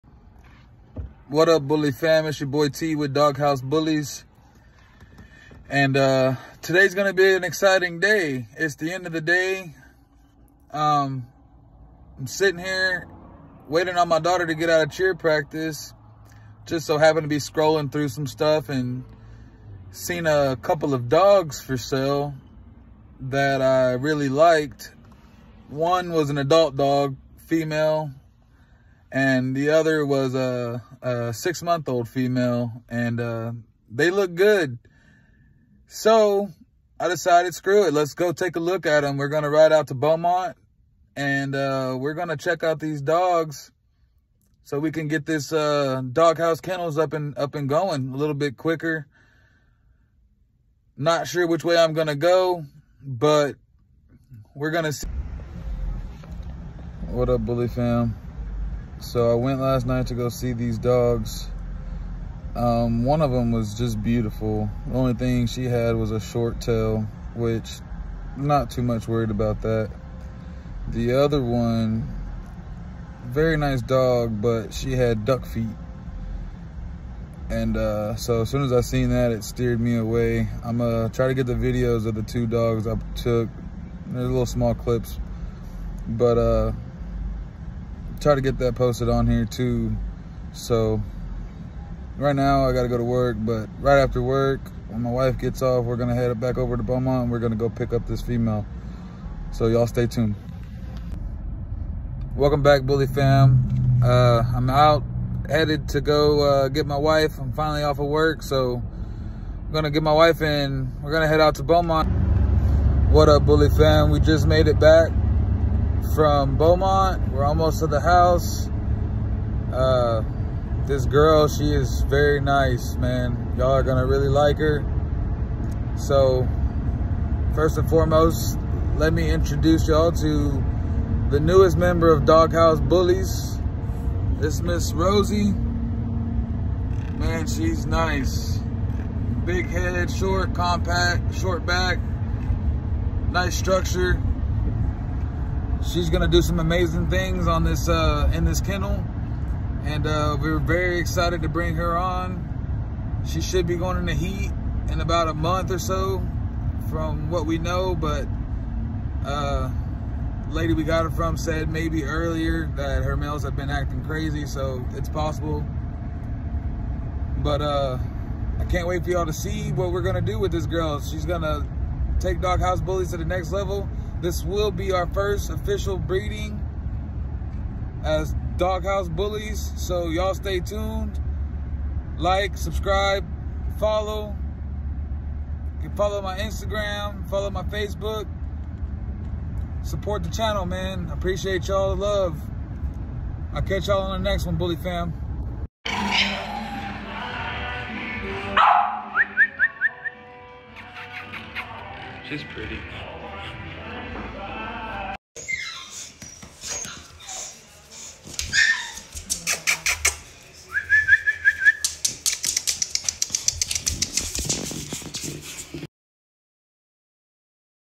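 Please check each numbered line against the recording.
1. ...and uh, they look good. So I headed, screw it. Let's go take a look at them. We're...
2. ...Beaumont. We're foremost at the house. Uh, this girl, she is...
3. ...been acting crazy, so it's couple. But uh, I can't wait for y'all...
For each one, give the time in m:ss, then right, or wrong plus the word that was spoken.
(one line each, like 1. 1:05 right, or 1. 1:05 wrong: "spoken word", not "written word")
1. 0:32 wrong: "decided", not "headed"
2. 1:56 wrong: "almost", not "foremost"
3. 2:43 wrong: "possible", not "couple".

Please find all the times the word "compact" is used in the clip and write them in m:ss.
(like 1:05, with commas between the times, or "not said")
2:20.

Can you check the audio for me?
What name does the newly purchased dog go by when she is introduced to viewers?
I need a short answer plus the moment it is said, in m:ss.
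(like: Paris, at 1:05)
Rosie, at 2:14.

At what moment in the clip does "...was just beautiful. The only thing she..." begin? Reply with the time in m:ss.
1:03.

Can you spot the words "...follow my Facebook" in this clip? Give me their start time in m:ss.
3:07.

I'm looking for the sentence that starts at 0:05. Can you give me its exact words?
And uh, today's going to be an exciting day.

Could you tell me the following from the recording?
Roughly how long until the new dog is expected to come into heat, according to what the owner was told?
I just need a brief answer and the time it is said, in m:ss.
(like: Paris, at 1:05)
About a month, at 2:35.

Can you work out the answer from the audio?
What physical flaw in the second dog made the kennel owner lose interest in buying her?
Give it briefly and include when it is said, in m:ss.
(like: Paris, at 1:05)
Duck feet, at 1:15.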